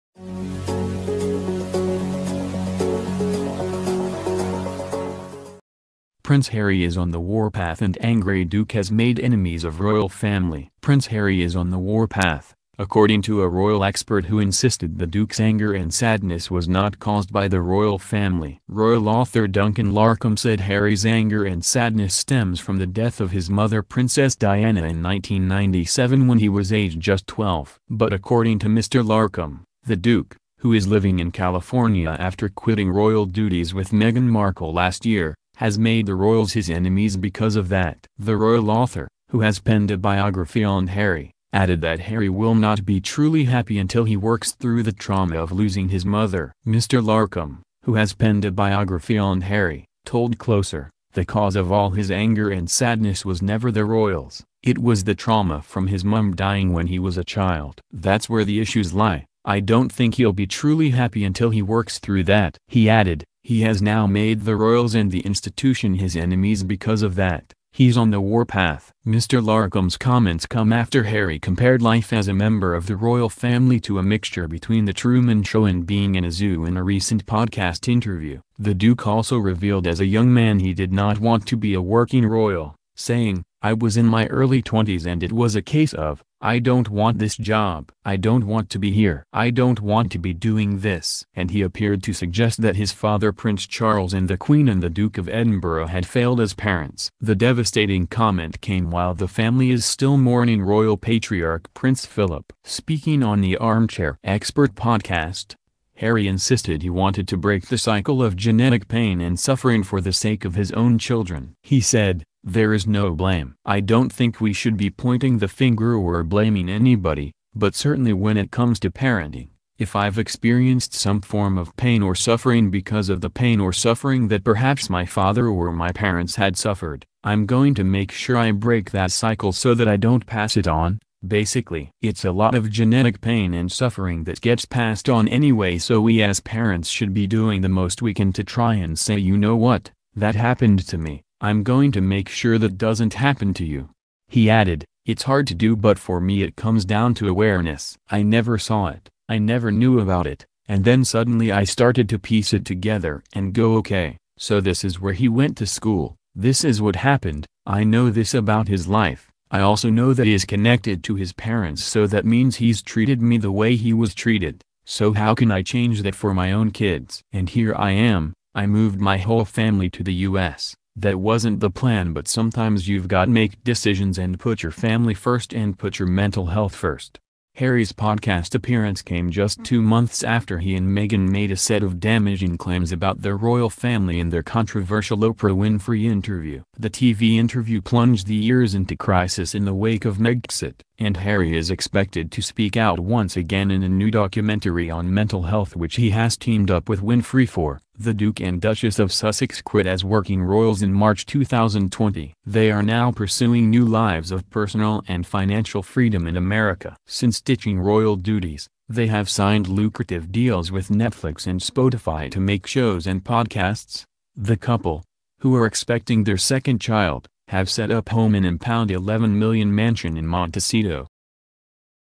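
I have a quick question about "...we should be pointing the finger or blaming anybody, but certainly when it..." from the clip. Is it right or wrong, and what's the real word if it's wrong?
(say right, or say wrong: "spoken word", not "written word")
right.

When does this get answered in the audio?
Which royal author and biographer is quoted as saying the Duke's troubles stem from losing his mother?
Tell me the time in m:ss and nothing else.
0:19.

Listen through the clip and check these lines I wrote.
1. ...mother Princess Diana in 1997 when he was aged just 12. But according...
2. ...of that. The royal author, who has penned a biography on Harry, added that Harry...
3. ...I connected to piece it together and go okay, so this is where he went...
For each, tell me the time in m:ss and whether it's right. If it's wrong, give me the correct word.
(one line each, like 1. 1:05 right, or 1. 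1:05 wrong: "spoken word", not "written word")
1. 0:23 right
2. 0:37 right
3. 2:31 wrong: "started", not "connected".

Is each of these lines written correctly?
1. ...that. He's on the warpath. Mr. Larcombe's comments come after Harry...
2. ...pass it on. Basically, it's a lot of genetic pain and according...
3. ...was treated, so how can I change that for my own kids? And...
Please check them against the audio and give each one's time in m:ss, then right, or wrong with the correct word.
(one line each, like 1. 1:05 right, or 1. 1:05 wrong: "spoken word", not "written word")
1. 1:07 right
2. 2:10 wrong: "suffering", not "according"
3. 2:43 right.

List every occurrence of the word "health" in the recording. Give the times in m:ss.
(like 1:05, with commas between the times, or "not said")
2:56, 3:15.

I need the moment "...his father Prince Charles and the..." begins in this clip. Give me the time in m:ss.
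1:32.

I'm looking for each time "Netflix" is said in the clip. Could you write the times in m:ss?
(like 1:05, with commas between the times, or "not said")
3:30.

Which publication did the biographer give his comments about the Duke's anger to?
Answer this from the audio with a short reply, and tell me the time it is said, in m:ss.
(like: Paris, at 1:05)
Closer, at 0:50.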